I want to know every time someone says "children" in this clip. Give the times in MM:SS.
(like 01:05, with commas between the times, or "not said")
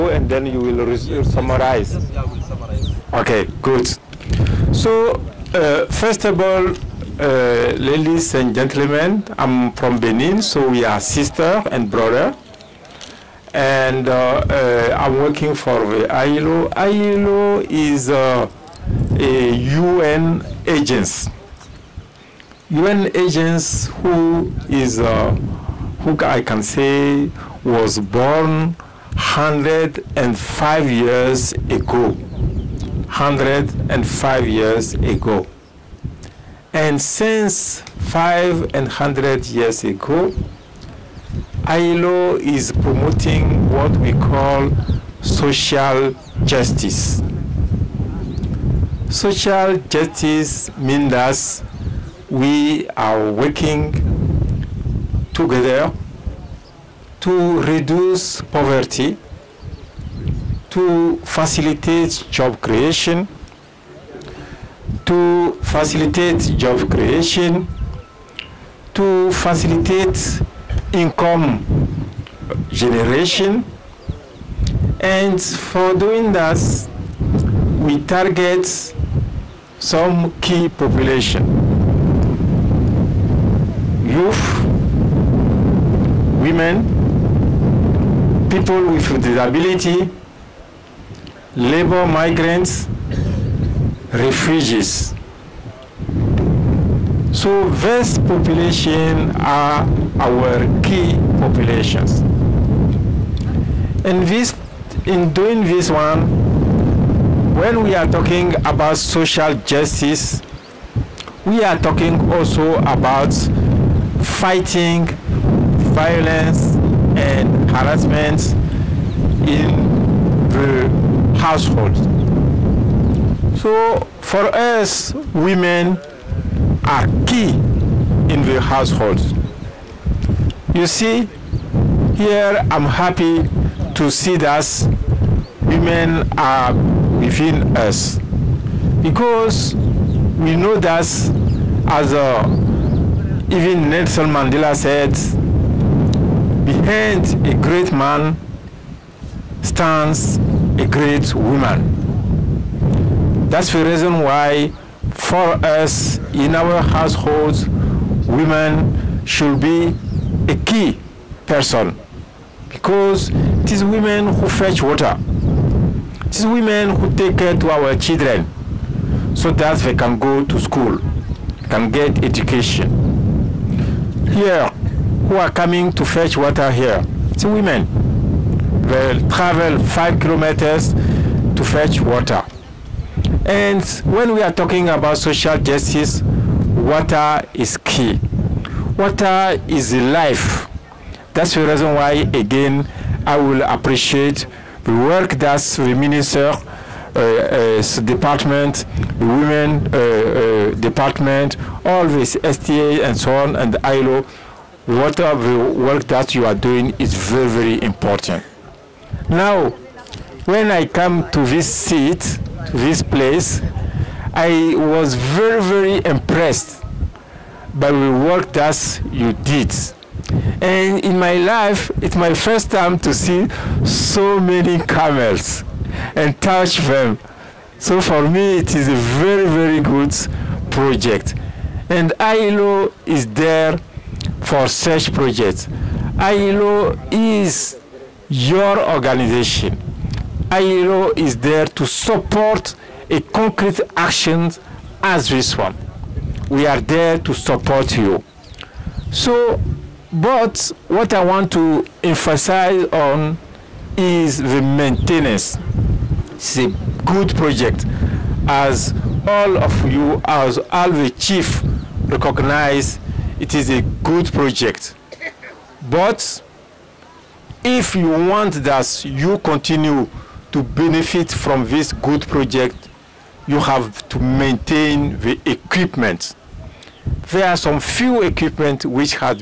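02:47.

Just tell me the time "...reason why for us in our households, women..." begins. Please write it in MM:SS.
02:33.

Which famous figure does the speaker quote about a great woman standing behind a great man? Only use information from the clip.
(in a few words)
Nelson Mandela.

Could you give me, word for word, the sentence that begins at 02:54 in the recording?
Here, who are coming to fetch water here.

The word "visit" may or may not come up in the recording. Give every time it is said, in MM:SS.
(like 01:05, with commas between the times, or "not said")
not said.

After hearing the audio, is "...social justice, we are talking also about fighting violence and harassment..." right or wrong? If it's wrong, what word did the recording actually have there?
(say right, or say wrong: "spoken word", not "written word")
right.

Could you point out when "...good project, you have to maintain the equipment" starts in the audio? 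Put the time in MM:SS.
04:31.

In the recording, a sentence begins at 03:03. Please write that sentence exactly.
And when we are talking about social justice, water is key.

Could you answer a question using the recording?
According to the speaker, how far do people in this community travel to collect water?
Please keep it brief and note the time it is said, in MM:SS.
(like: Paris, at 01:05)
5 kilometers, at 02:59.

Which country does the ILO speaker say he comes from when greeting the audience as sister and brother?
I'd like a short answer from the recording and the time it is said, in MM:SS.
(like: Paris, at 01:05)
Benin, at 00:09.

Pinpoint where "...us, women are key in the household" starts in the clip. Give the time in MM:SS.
02:04.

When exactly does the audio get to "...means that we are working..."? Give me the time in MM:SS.
00:50.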